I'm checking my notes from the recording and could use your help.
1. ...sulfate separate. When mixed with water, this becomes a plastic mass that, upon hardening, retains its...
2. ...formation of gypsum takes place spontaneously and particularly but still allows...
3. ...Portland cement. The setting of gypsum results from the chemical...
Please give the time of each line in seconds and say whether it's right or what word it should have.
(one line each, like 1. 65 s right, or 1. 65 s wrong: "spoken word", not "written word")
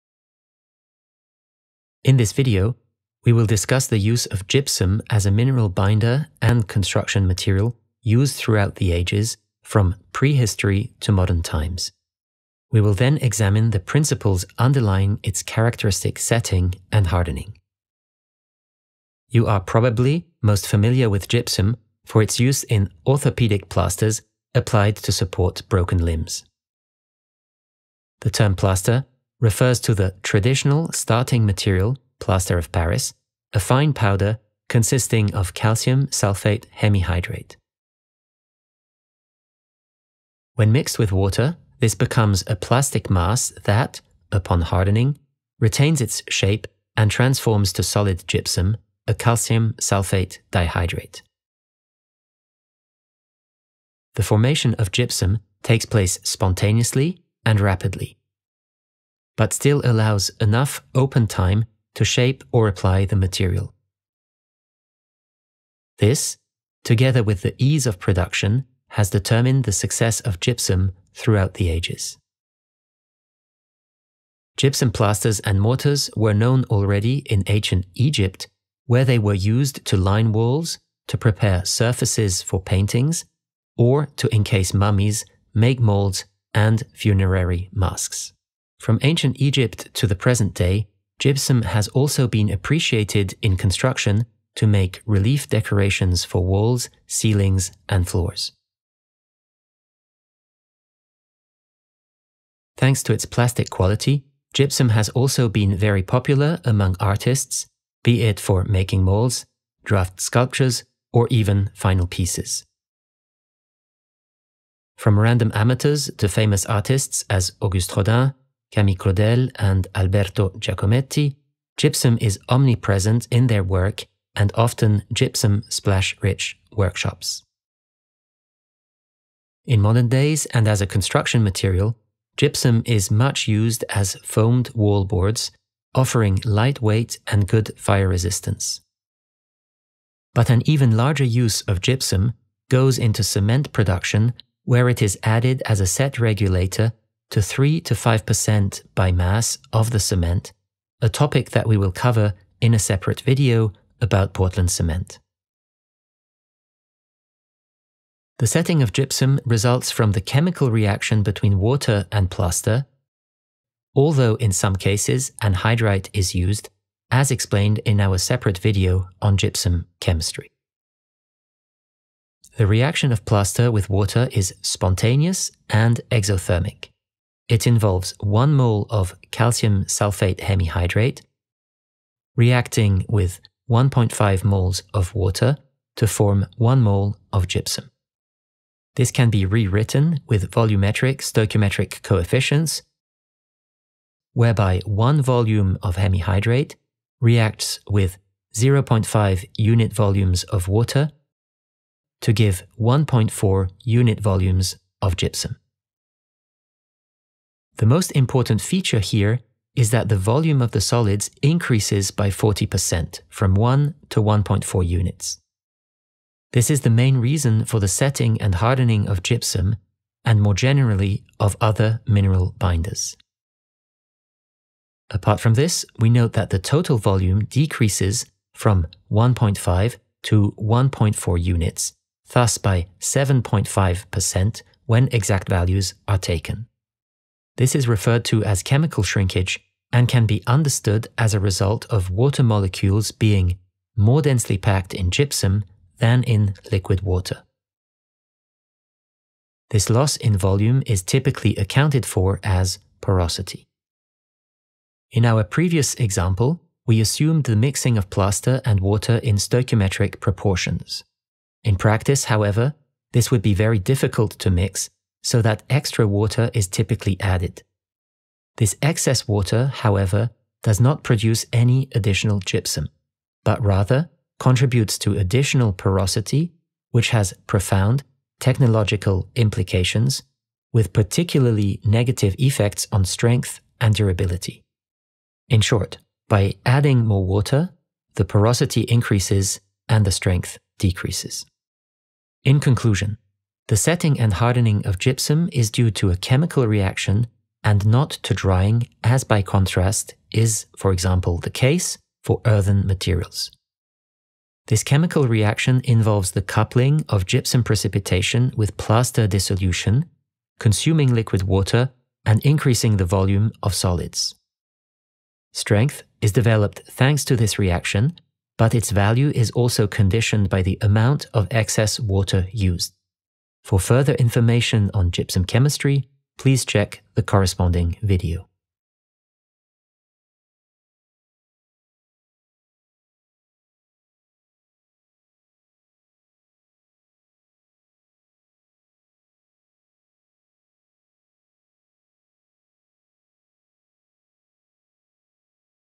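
1. 36 s wrong: "hemihydrate", not "separate"
2. 54 s wrong: "rapidly", not "particularly"
3. 154 s right.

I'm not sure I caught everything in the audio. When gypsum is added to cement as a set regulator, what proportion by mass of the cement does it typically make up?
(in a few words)
3 to 5%.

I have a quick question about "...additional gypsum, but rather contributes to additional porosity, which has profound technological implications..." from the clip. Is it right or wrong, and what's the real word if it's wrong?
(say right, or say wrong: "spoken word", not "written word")
right.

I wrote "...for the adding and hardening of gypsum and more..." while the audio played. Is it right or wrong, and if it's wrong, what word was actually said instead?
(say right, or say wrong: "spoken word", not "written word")
wrong: "setting", not "adding".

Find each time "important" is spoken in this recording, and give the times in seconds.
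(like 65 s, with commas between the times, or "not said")
208 s.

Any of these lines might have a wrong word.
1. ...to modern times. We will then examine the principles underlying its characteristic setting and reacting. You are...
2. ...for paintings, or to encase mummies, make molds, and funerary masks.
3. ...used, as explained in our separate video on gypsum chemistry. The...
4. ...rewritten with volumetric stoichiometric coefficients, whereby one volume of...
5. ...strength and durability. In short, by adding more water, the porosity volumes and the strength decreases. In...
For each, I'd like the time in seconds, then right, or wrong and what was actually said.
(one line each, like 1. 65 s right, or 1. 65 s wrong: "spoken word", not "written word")
1. 11 s wrong: "hardening", not "reacting"
2. 82 s right
3. 166 s right
4. 189 s right
5. 283 s wrong: "increases", not "volumes".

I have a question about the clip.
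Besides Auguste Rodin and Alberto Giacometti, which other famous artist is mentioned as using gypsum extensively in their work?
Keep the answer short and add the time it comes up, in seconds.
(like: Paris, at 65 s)
Camille Claudel, at 118 s.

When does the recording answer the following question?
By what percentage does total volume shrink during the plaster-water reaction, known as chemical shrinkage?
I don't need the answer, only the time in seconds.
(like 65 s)
232 s.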